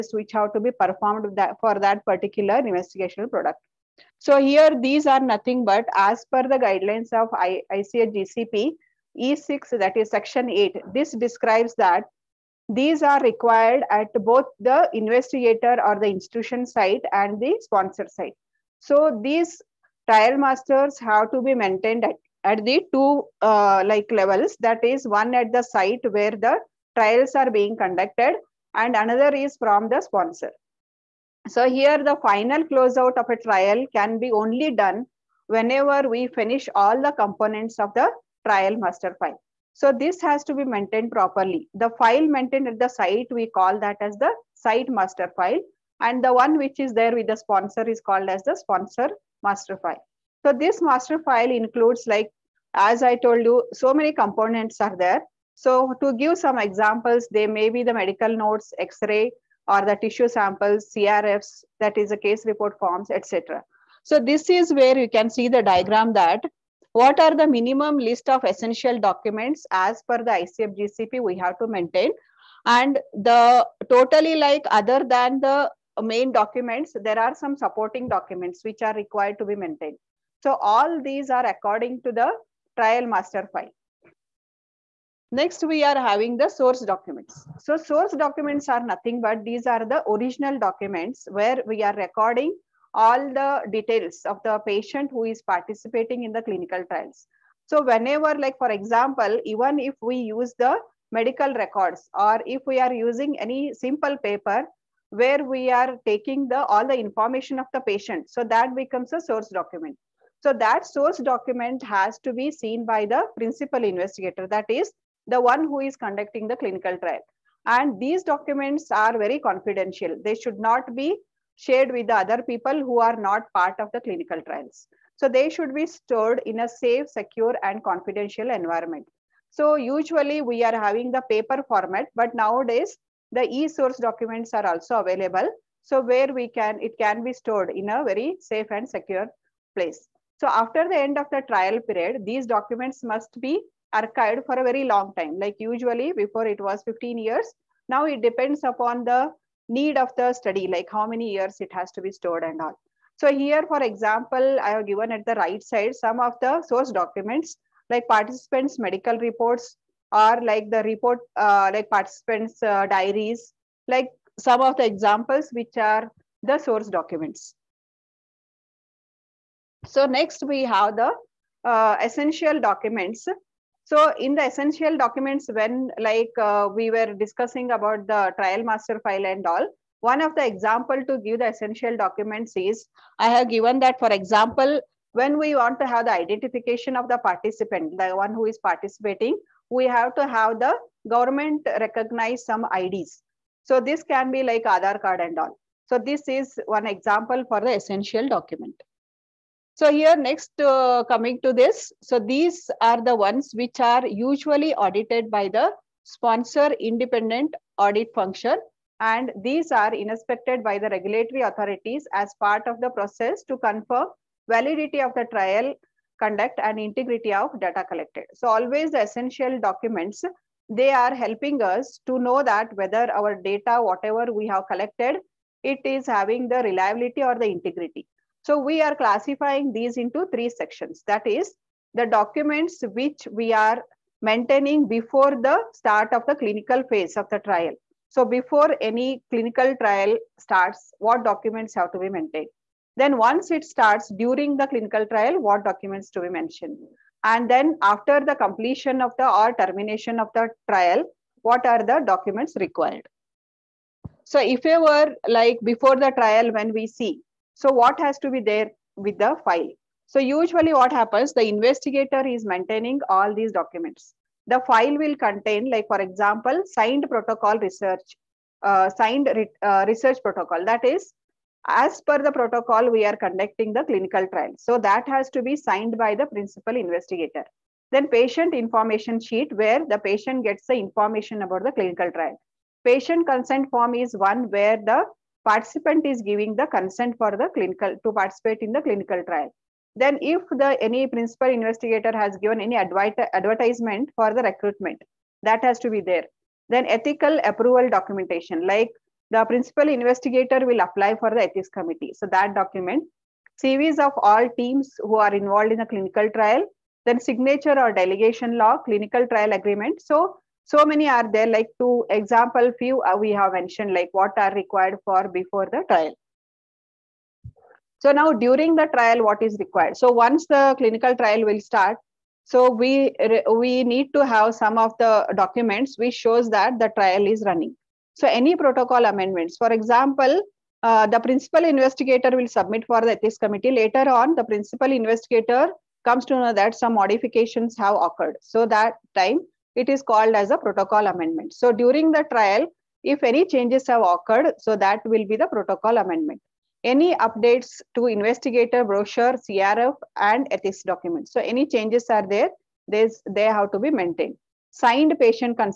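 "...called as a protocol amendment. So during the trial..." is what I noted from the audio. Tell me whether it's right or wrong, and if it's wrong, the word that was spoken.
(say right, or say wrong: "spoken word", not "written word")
right.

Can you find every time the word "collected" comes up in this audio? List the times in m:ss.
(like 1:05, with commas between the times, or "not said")
3:37, 3:44.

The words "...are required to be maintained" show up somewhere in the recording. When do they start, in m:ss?
1:18.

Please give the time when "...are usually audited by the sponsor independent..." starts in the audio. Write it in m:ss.
3:23.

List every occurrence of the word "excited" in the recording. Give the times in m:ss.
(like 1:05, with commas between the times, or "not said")
not said.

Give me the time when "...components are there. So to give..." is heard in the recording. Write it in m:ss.
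0:54.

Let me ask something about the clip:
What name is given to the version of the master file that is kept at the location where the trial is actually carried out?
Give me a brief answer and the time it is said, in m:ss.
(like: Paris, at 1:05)
Site master file, at 0:44.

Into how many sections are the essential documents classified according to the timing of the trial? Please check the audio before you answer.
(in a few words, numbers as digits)
3.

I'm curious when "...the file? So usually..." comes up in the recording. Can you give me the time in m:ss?
4:19.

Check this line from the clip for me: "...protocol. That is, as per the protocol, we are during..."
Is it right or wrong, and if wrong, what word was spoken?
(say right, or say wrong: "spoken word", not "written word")
wrong: "conducting", not "during".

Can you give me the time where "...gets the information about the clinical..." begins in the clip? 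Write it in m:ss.
4:40.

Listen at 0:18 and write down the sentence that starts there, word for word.
So these trial masters have to be maintained at, at the two uh, like levels.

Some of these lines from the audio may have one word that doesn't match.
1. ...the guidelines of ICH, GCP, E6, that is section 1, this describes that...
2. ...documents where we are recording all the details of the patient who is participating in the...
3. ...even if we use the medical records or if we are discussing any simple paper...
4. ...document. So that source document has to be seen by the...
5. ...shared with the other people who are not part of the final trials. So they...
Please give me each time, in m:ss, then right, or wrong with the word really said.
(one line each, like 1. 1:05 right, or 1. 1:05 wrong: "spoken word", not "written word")
1. 0:06 wrong: "8", not "1"
2. 1:30 right
3. 1:39 wrong: "using", not "discussing"
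4. 1:49 right
5. 2:01 wrong: "clinical", not "final".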